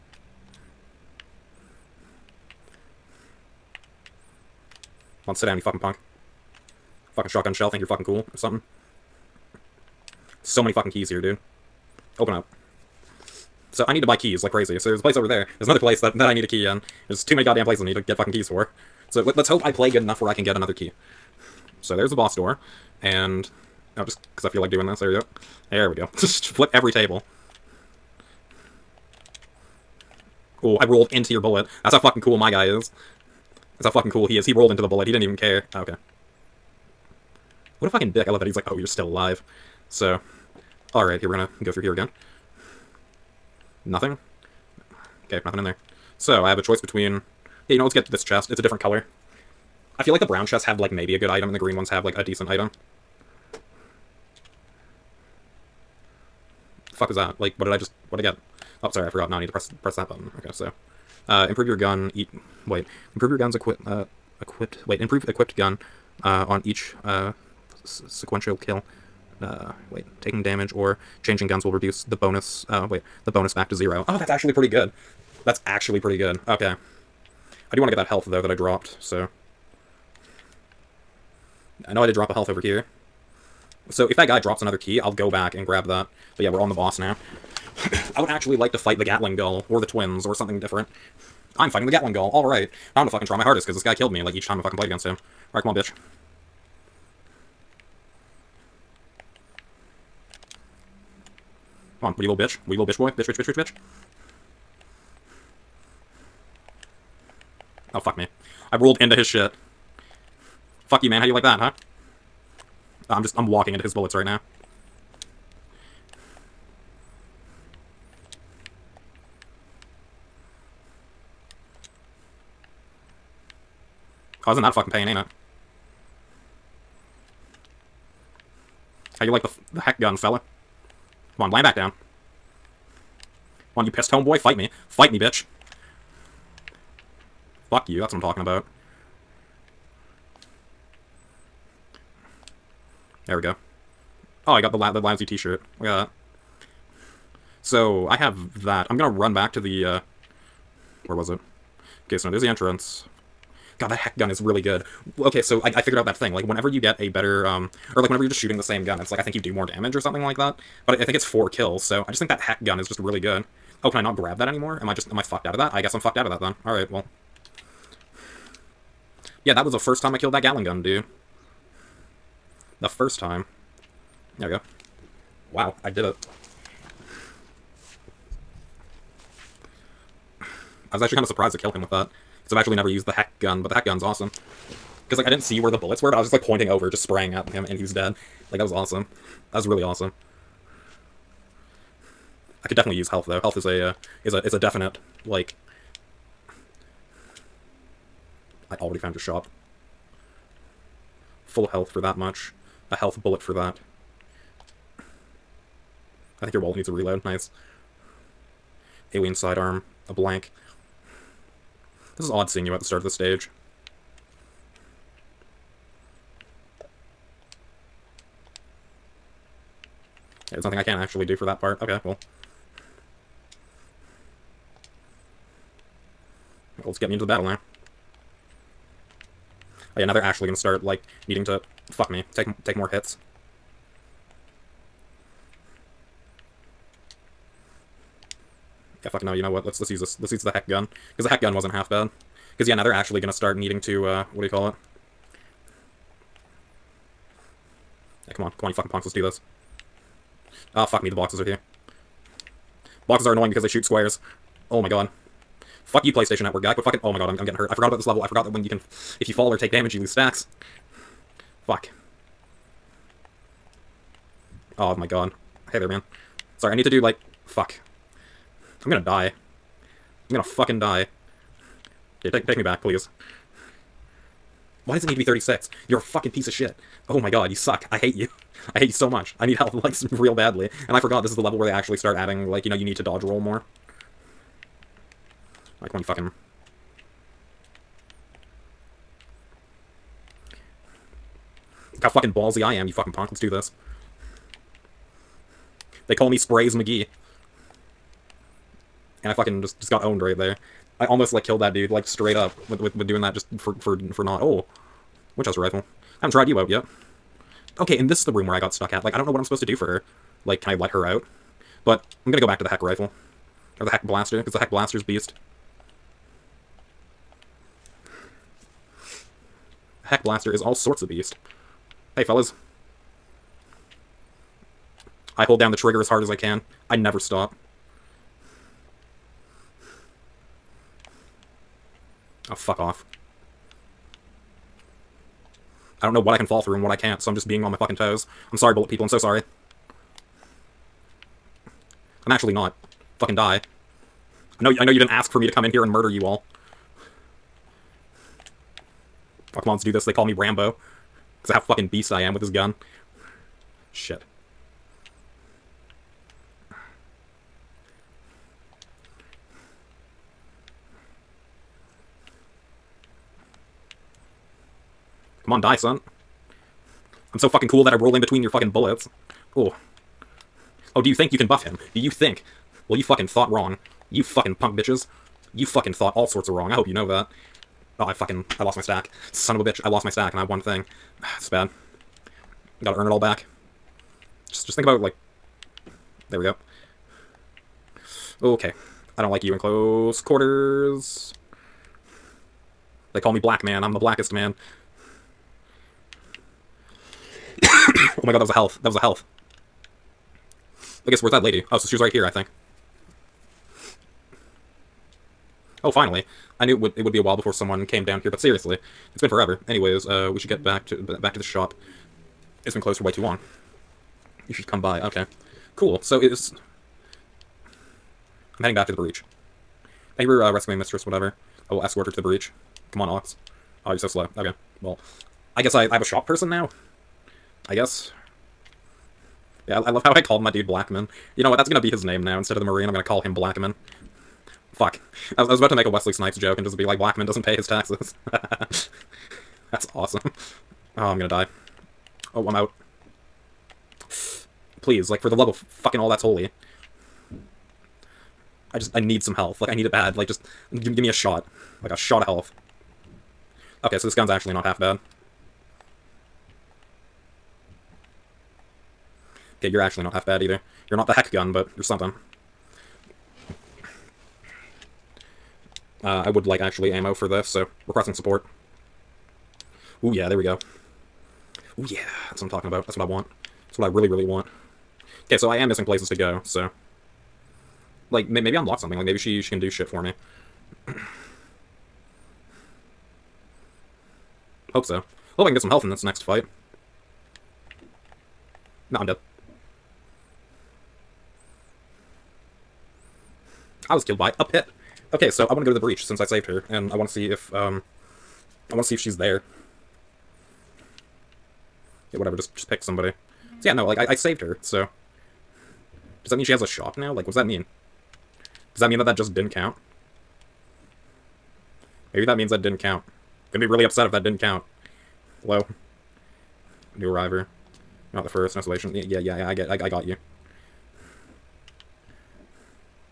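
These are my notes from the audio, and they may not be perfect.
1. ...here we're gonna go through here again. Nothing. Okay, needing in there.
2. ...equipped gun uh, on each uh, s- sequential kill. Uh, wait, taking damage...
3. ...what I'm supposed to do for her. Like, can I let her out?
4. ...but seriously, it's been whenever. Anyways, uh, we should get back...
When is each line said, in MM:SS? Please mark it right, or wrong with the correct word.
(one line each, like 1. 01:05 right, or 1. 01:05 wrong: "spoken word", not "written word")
1. 00:41 wrong: "nothing", not "needing"
2. 01:05 right
3. 05:09 right
4. 06:48 wrong: "forever", not "whenever".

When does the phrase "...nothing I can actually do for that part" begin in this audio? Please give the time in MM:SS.
03:40.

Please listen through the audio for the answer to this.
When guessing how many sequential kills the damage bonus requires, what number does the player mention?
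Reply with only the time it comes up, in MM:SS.
02:41.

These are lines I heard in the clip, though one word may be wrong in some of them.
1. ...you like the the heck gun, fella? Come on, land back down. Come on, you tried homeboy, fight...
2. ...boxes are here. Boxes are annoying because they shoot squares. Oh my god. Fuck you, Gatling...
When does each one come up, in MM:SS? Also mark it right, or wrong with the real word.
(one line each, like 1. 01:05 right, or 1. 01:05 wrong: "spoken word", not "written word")
1. 02:09 wrong: "pissed", not "tried"
2. 04:11 wrong: "PlayStation", not "Gatling".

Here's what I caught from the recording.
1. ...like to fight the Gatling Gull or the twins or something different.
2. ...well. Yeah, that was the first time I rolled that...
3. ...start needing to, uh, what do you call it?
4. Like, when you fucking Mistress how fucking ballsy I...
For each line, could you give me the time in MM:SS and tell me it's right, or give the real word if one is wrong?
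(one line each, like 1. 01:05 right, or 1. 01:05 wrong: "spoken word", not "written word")
1. 01:28 right
2. 02:46 wrong: "killed", not "rolled"
3. 04:03 right
4. 04:45 wrong: "Look", not "Mistress".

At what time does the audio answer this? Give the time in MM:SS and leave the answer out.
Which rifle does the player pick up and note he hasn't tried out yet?
05:05.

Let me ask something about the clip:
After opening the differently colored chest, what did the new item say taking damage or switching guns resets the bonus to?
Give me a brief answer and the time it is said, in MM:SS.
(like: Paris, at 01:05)
0, at 01:13.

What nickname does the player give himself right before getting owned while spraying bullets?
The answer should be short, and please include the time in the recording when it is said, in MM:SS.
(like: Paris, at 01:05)
Sprays McGee, at 04:56.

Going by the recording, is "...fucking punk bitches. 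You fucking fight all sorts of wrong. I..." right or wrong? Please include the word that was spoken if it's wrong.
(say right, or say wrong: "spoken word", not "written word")
wrong: "thought", not "fight".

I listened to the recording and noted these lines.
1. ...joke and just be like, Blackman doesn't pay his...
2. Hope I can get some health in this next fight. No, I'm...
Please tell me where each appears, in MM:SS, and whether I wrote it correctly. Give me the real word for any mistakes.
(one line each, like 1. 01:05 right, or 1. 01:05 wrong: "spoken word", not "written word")
1. 07:16 right
2. 08:05 right.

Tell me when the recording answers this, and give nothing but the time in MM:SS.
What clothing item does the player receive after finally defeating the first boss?
02:24.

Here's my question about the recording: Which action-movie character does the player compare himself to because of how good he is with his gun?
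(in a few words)
Rambo.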